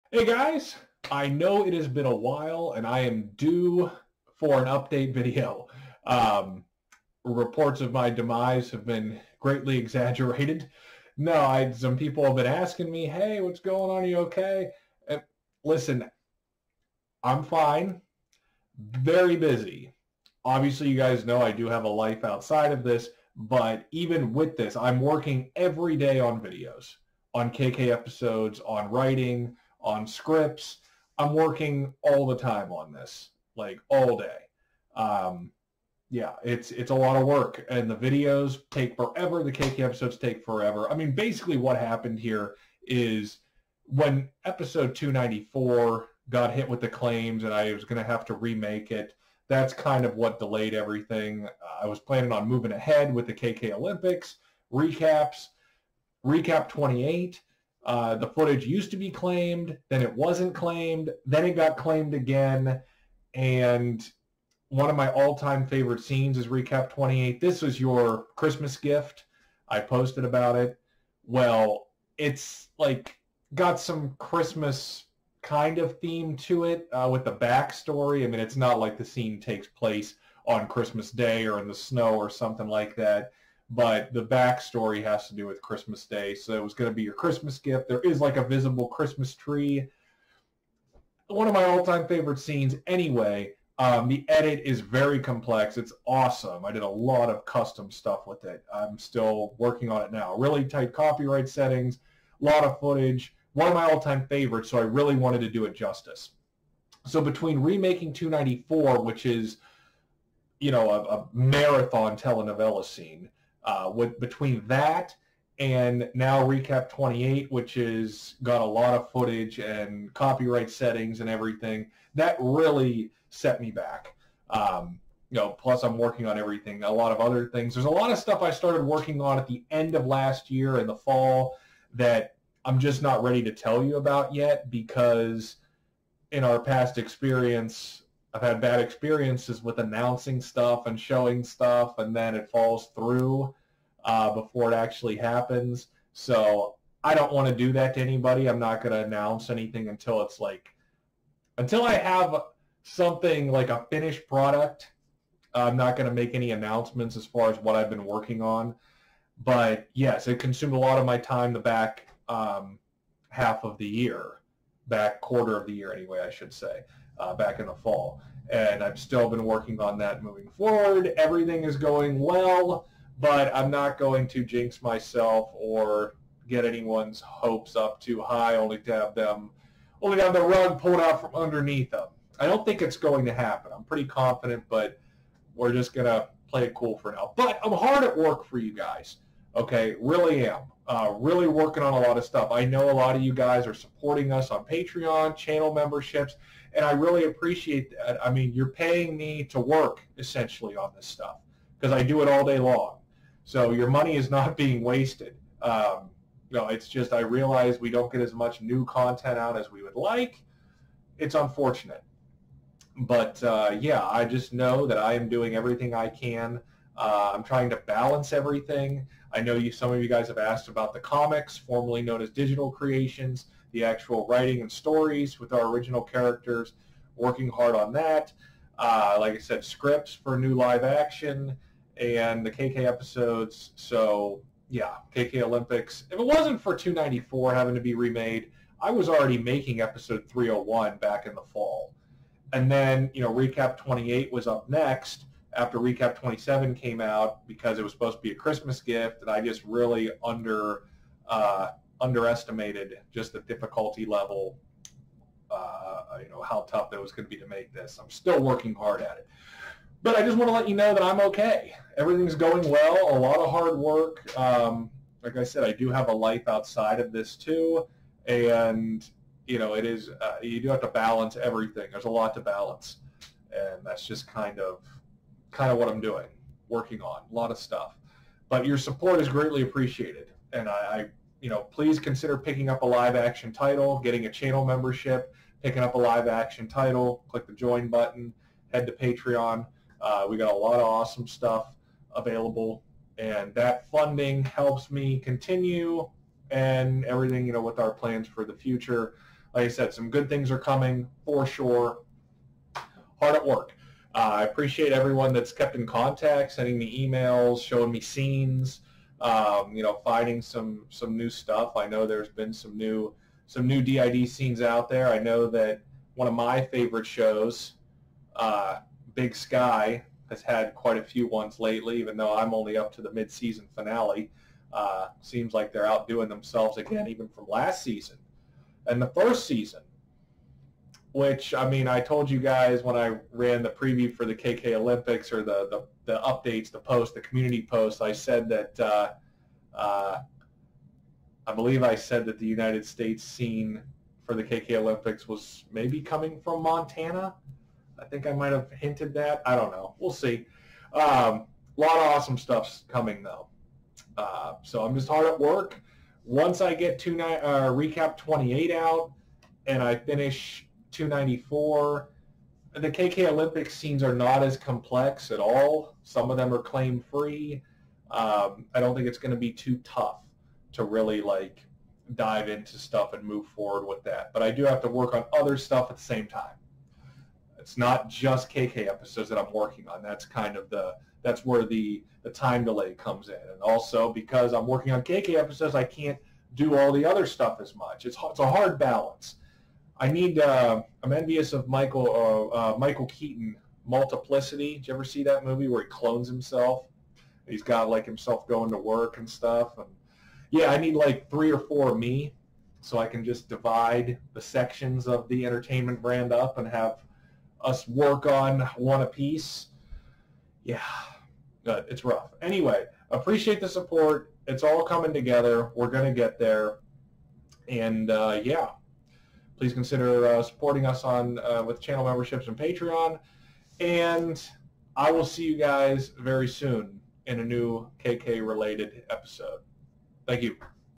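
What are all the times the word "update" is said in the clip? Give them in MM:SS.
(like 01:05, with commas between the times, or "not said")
00:04, 05:36.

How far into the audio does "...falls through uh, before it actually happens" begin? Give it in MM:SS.
02:22.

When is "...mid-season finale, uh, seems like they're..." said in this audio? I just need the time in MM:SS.
05:23.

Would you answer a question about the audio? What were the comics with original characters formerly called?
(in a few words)
digital creations.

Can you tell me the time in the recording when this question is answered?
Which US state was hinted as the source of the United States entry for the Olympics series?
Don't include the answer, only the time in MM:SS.
05:46.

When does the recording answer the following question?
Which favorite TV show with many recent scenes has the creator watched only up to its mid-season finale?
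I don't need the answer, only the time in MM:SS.
05:19.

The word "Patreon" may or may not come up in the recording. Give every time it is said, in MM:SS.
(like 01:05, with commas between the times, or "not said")
03:14, 04:48, 07:02.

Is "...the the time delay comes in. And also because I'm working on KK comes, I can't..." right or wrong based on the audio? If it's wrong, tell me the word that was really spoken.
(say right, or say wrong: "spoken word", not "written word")
wrong: "episodes", not "comes".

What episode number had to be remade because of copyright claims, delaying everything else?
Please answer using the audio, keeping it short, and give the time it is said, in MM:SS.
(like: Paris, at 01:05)
294, at 00:44.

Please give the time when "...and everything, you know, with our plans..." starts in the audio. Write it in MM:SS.
04:56.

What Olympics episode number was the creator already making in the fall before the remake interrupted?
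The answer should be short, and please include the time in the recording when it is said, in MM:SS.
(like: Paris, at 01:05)
301, at 03:59.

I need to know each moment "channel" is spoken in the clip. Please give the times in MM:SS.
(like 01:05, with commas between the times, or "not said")
03:15, 04:44, 07:01.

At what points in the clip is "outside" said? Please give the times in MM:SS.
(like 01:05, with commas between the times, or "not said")
00:22, 04:26.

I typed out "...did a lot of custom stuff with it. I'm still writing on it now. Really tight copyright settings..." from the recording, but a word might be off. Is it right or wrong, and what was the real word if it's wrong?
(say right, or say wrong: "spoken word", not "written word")
wrong: "working", not "writing".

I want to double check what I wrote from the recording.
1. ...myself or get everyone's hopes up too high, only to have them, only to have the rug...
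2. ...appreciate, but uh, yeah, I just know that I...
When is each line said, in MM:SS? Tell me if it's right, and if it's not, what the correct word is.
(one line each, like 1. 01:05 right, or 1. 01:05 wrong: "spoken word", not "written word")
1. 02:54 wrong: "anyone", not "everyone"
2. 03:31 wrong: "unfortunate", not "appreciate".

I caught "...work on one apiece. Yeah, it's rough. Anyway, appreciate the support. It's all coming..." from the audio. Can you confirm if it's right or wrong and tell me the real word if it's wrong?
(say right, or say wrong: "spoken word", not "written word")
right.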